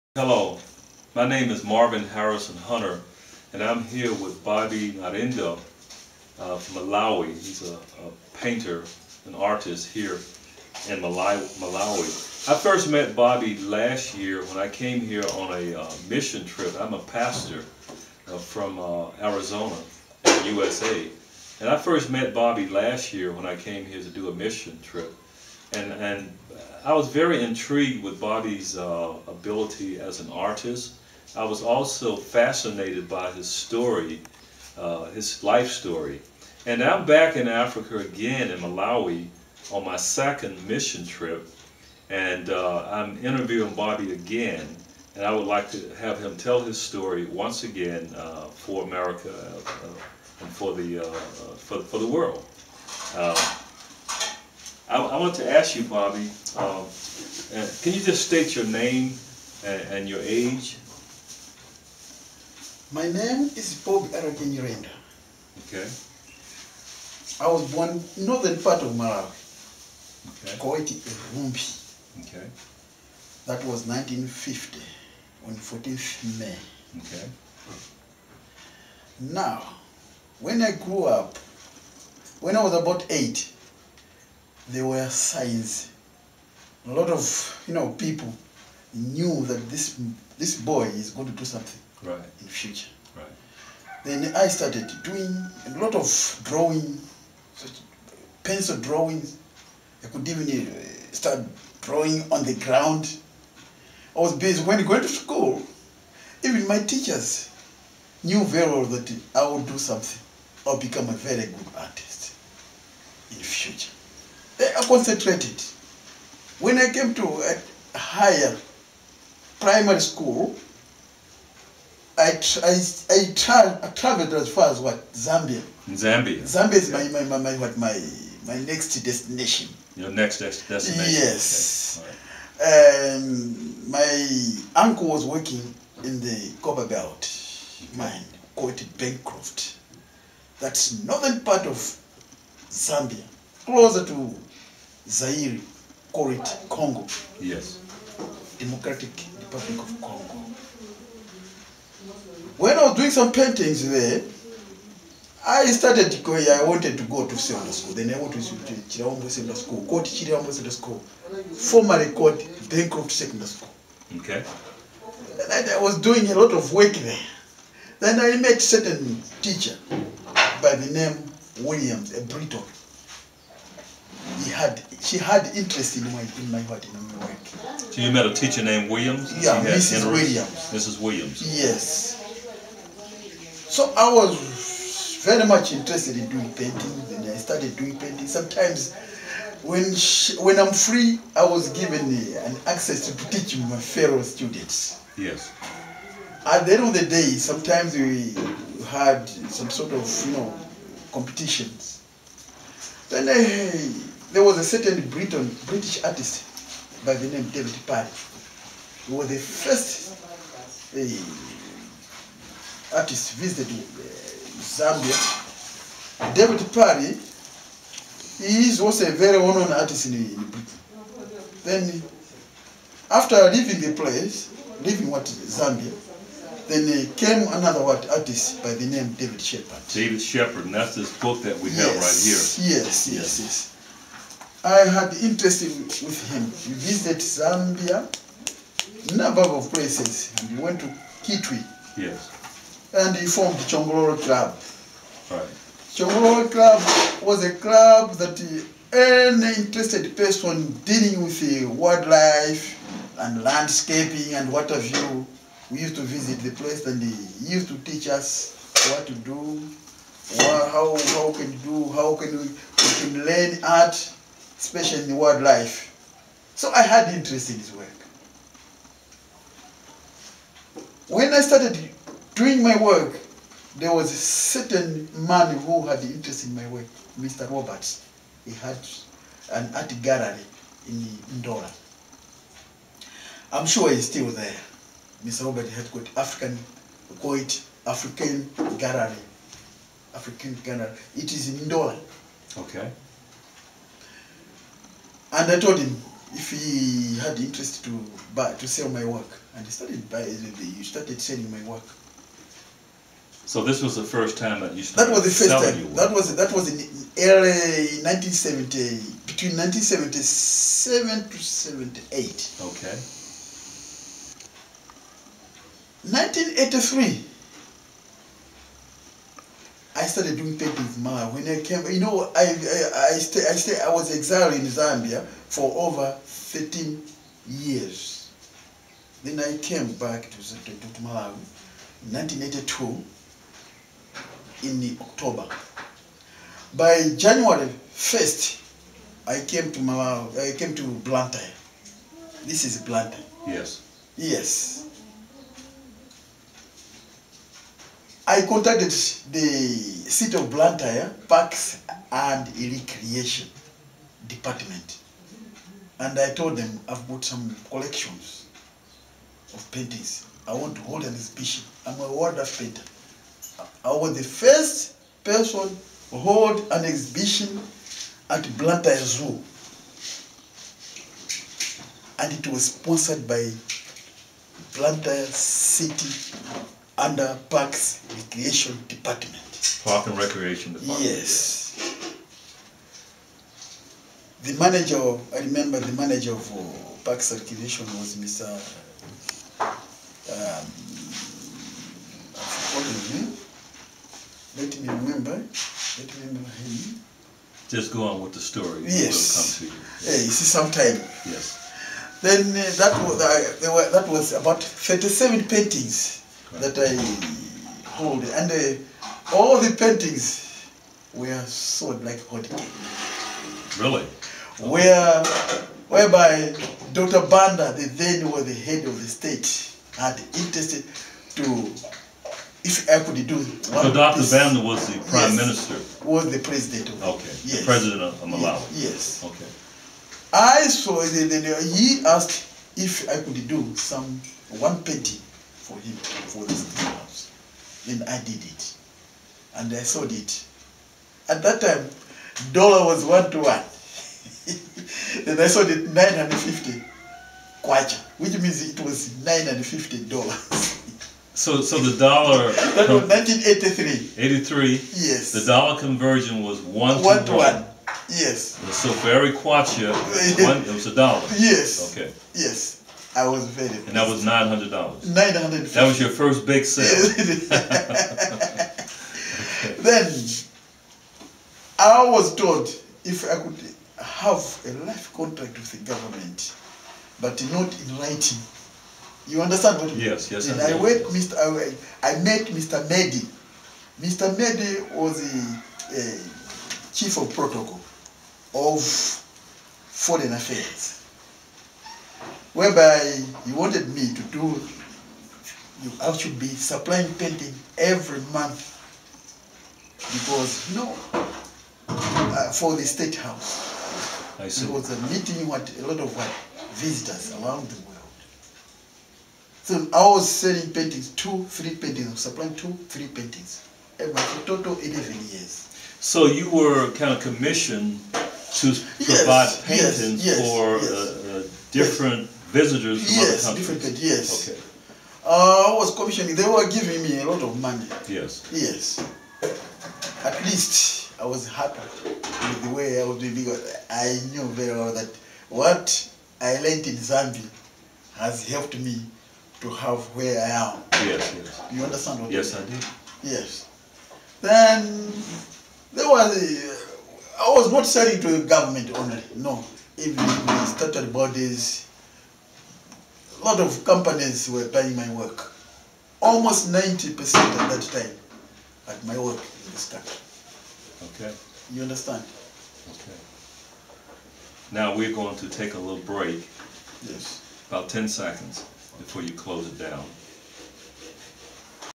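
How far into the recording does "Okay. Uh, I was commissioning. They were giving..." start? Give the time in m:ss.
8:44.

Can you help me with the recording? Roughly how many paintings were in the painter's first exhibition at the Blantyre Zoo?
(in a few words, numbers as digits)
37.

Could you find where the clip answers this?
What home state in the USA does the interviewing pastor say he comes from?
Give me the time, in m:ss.
0:19.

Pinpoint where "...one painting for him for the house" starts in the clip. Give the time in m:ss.
7:14.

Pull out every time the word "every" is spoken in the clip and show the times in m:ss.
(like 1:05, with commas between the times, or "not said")
7:39, 8:17, 8:33.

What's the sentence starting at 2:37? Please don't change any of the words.
Then I went to Chirambo Senda School, go to Chirambo School, formerly called Bancroft Secondary School.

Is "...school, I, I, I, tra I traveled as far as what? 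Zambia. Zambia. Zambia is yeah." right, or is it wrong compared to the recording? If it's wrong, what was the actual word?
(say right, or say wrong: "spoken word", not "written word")
right.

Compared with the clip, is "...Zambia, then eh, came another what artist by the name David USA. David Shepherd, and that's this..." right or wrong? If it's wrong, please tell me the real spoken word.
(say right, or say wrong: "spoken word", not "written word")
wrong: "Shepherd", not "USA".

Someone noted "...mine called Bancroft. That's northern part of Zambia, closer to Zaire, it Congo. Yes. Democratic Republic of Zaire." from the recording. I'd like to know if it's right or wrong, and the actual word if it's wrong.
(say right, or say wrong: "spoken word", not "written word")
wrong: "Congo", not "Zaire".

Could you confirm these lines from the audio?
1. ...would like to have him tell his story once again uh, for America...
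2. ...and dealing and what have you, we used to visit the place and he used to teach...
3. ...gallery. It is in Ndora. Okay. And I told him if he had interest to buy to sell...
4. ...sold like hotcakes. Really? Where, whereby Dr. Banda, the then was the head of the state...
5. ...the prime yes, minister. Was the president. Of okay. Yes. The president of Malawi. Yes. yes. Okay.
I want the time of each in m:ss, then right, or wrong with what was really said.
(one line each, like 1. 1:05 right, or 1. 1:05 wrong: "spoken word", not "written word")
1. 0:45 right
2. 4:13 wrong: "landscaping", not "dealing"
3. 4:50 right
4. 6:51 right
5. 7:04 right.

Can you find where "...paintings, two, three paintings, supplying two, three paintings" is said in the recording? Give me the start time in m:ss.
8:30.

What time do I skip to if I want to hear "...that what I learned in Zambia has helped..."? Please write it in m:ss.
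8:54.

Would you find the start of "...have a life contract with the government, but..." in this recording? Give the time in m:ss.
7:54.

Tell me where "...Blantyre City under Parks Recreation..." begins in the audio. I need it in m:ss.
6:14.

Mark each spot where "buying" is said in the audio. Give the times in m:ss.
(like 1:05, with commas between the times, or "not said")
5:00, 9:14.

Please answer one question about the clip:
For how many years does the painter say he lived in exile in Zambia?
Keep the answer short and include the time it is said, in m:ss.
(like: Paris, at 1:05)
13 years, at 5:25.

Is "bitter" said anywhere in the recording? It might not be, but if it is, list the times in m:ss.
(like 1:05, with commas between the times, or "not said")
not said.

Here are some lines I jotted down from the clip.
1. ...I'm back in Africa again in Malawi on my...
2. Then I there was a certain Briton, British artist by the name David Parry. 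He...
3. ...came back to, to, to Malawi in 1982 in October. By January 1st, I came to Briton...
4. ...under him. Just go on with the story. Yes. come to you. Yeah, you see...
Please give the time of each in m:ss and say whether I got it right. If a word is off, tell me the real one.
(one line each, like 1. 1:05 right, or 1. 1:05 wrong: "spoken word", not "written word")
1. 0:36 right
2. 3:23 right
3. 5:29 wrong: "Malawi", not "Briton"
4. 6:36 wrong: "remember", not "under".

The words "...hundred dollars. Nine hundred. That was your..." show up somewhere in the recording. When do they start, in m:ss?
7:44.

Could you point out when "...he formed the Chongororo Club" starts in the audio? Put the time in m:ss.
4:03.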